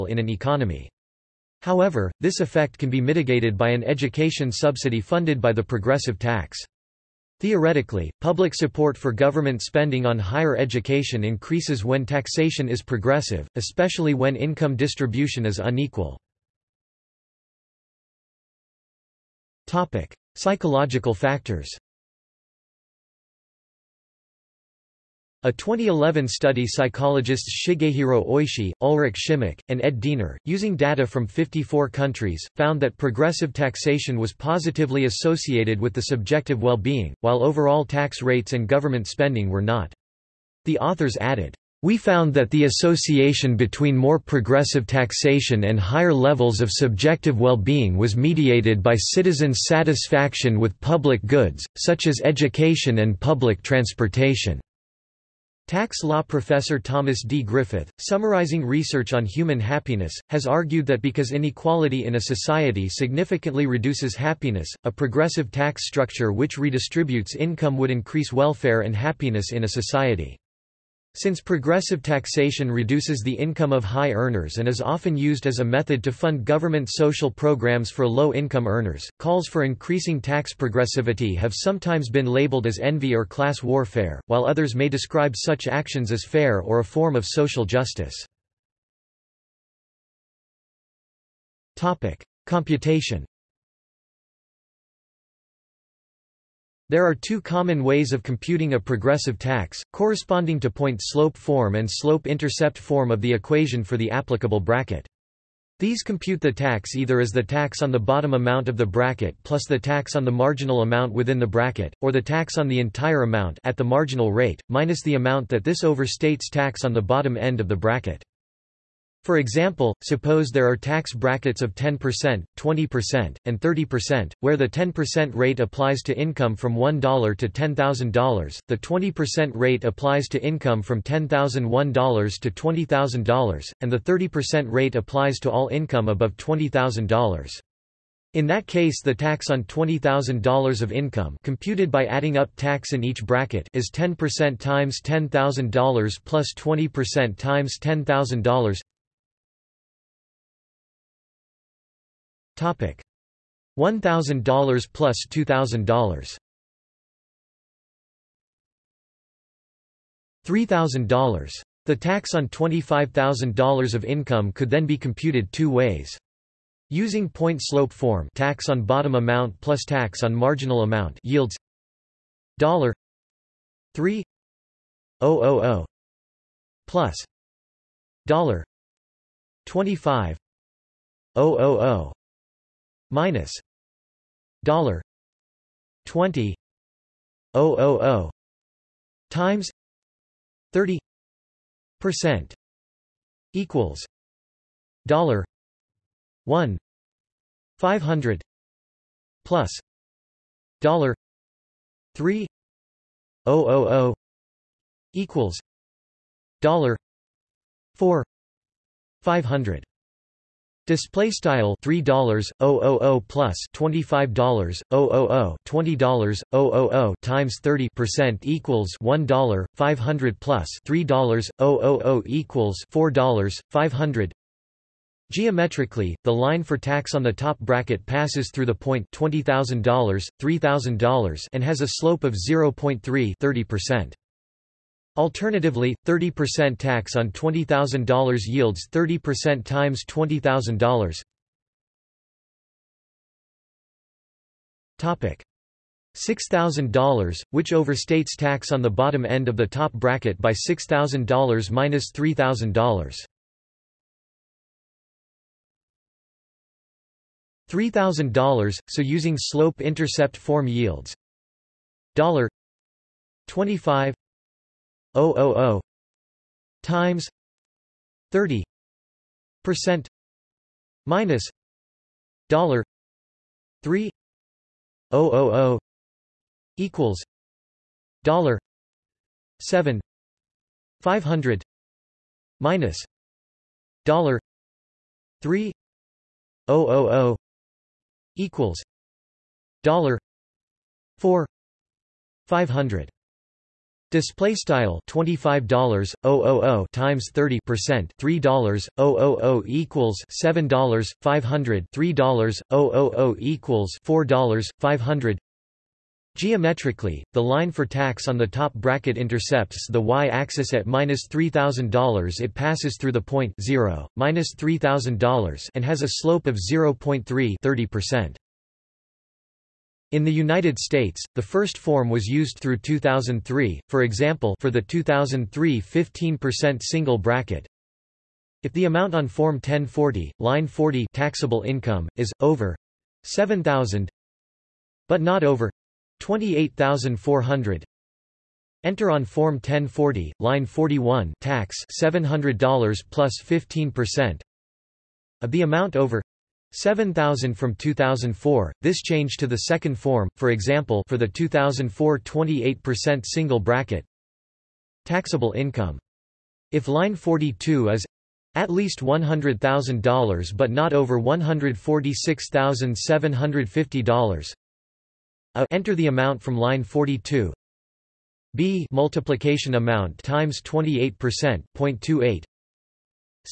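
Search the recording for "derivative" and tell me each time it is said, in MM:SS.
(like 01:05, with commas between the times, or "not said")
not said.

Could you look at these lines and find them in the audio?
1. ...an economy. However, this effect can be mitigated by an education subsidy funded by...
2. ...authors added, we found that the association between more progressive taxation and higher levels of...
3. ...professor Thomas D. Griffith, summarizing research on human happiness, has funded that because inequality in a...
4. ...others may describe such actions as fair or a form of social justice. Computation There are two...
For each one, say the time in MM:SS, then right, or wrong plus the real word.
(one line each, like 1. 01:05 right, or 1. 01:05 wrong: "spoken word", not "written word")
1. 00:00 right
2. 00:40 right
3. 00:56 wrong: "argued", not "funded"
4. 01:24 right.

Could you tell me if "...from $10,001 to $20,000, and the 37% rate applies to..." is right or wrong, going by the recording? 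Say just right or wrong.
wrong.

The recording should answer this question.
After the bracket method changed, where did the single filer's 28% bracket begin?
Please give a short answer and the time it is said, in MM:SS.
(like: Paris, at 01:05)
$100,000, at 05:58.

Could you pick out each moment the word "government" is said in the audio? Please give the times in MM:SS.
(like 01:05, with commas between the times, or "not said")
00:09, 00:38, 01:16.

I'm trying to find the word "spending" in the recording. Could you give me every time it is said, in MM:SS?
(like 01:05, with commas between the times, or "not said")
00:09, 00:39.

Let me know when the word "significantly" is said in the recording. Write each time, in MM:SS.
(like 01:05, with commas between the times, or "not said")
01:02.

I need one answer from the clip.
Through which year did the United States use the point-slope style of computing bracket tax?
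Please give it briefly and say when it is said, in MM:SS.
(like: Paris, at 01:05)
2003, at 05:22.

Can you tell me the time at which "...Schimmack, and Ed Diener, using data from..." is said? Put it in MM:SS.
00:29.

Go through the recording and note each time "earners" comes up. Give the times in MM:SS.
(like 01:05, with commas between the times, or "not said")
01:14, 01:18.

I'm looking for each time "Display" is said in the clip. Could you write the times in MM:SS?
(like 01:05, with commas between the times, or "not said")
03:30, 04:54.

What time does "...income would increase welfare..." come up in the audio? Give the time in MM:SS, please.
01:07.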